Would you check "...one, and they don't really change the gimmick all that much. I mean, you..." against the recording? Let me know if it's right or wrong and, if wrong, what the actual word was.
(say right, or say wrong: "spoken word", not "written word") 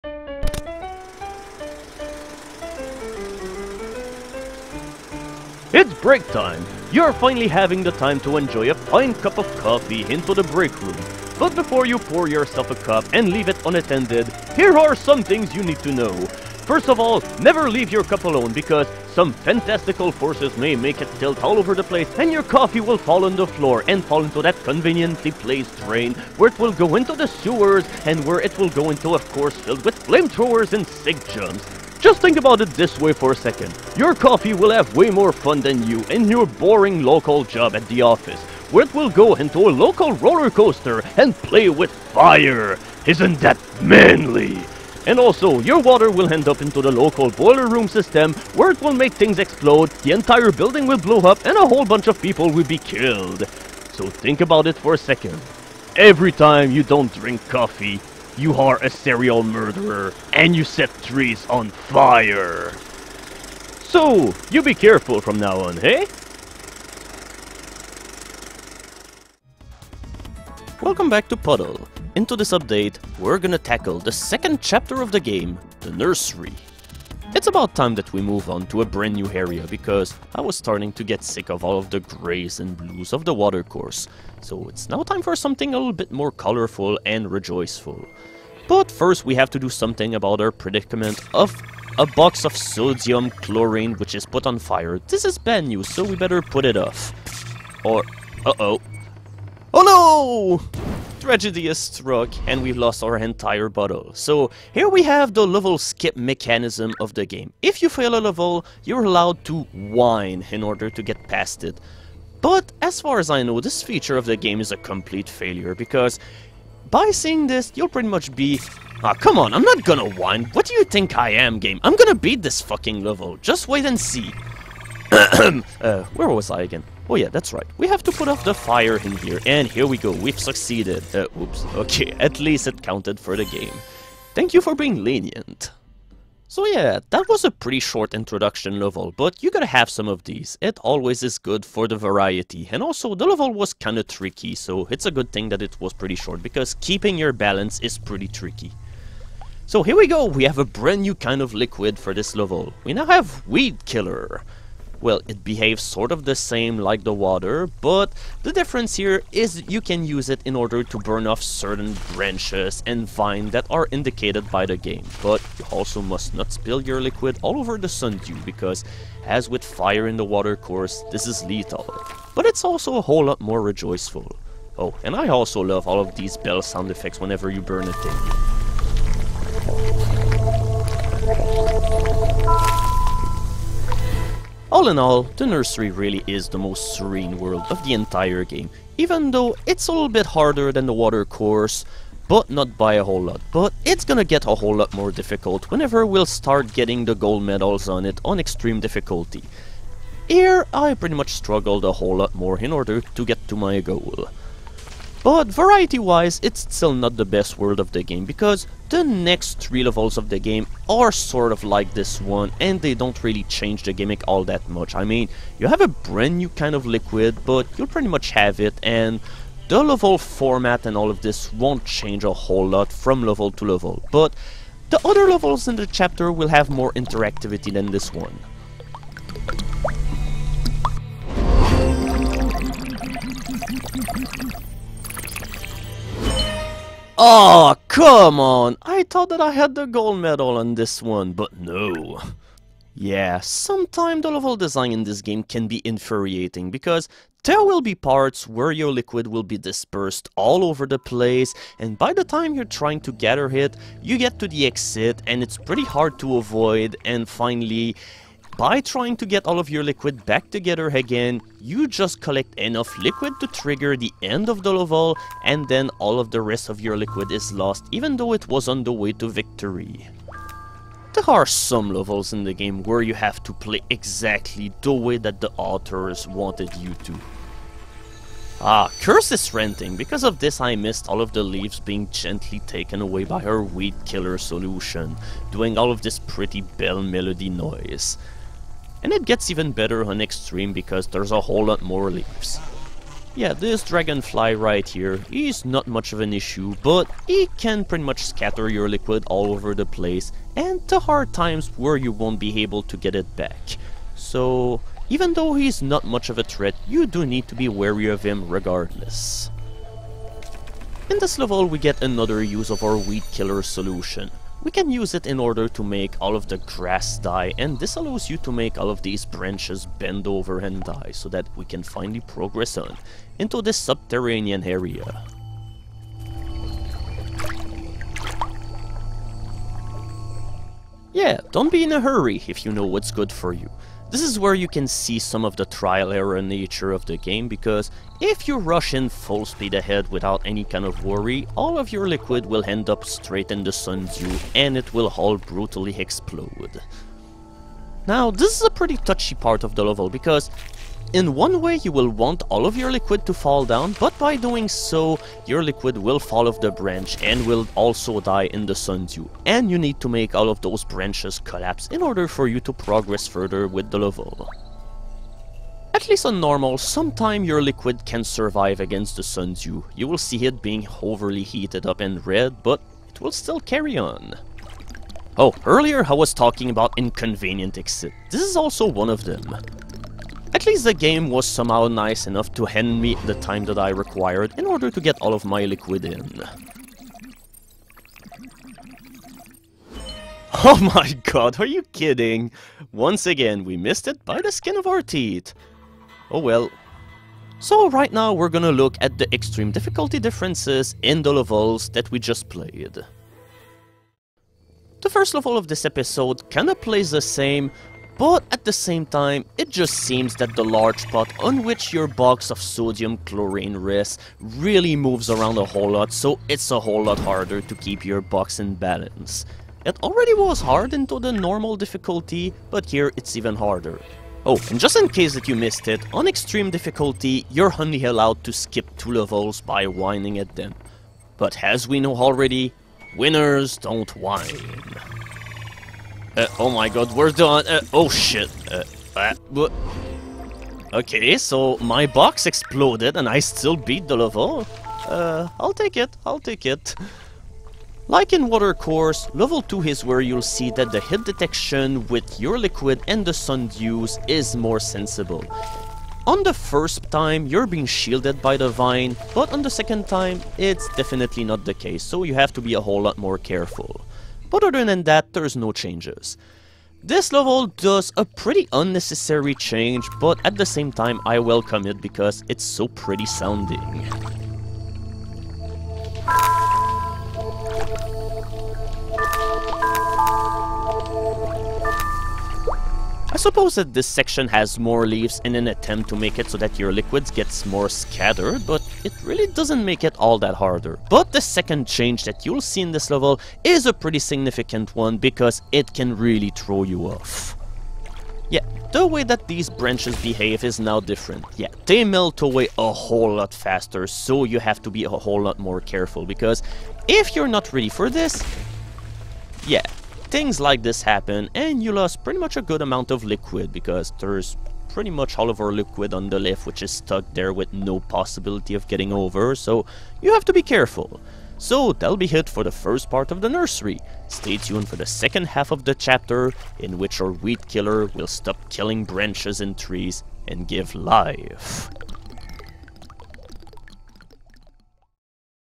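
right.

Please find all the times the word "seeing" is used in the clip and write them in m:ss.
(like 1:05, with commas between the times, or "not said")
1:57.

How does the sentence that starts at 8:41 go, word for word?
So that'll be it for the first part of the nursery.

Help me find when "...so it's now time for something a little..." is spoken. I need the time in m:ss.
1:24.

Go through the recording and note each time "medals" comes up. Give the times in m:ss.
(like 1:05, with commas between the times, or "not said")
3:17, 4:00.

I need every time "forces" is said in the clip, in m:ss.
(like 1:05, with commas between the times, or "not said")
0:20.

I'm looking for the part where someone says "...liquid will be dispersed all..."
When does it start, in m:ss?
4:08.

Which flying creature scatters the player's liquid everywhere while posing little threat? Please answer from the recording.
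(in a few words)
Dragonfly.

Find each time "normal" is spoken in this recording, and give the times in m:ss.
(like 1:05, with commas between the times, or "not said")
6:06, 7:01.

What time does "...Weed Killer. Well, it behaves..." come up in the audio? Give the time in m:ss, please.
2:33.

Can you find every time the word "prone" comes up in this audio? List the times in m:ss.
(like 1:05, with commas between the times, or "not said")
not said.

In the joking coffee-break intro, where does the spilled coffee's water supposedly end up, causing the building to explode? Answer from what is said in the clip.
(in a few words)
boiler room system.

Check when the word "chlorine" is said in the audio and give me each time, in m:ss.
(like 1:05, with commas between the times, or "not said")
1:33, 6:53.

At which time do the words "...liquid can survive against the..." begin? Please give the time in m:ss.
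6:07.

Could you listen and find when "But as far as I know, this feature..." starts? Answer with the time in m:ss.
1:52.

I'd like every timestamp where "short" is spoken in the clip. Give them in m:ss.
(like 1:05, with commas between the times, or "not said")
2:17, 2:26.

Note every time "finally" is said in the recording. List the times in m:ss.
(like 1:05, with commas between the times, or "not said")
0:07, 4:17, 5:21.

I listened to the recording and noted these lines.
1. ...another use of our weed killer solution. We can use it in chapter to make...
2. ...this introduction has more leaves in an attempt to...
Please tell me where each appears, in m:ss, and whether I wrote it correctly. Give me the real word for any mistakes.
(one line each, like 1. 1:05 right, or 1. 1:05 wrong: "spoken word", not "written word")
1. 5:12 wrong: "order", not "chapter"
2. 8:03 wrong: "section", not "introduction".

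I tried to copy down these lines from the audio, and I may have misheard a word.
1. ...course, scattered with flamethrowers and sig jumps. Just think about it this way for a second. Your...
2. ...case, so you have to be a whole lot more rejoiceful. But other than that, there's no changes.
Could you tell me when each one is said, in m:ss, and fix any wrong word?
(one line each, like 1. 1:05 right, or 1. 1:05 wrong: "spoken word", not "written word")
1. 0:29 wrong: "filled", not "scattered"
2. 7:41 wrong: "careful", not "rejoiceful".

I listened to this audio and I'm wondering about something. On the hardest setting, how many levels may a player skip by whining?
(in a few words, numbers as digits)
2.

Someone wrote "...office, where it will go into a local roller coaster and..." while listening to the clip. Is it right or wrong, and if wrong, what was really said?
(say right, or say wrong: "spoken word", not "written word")
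right.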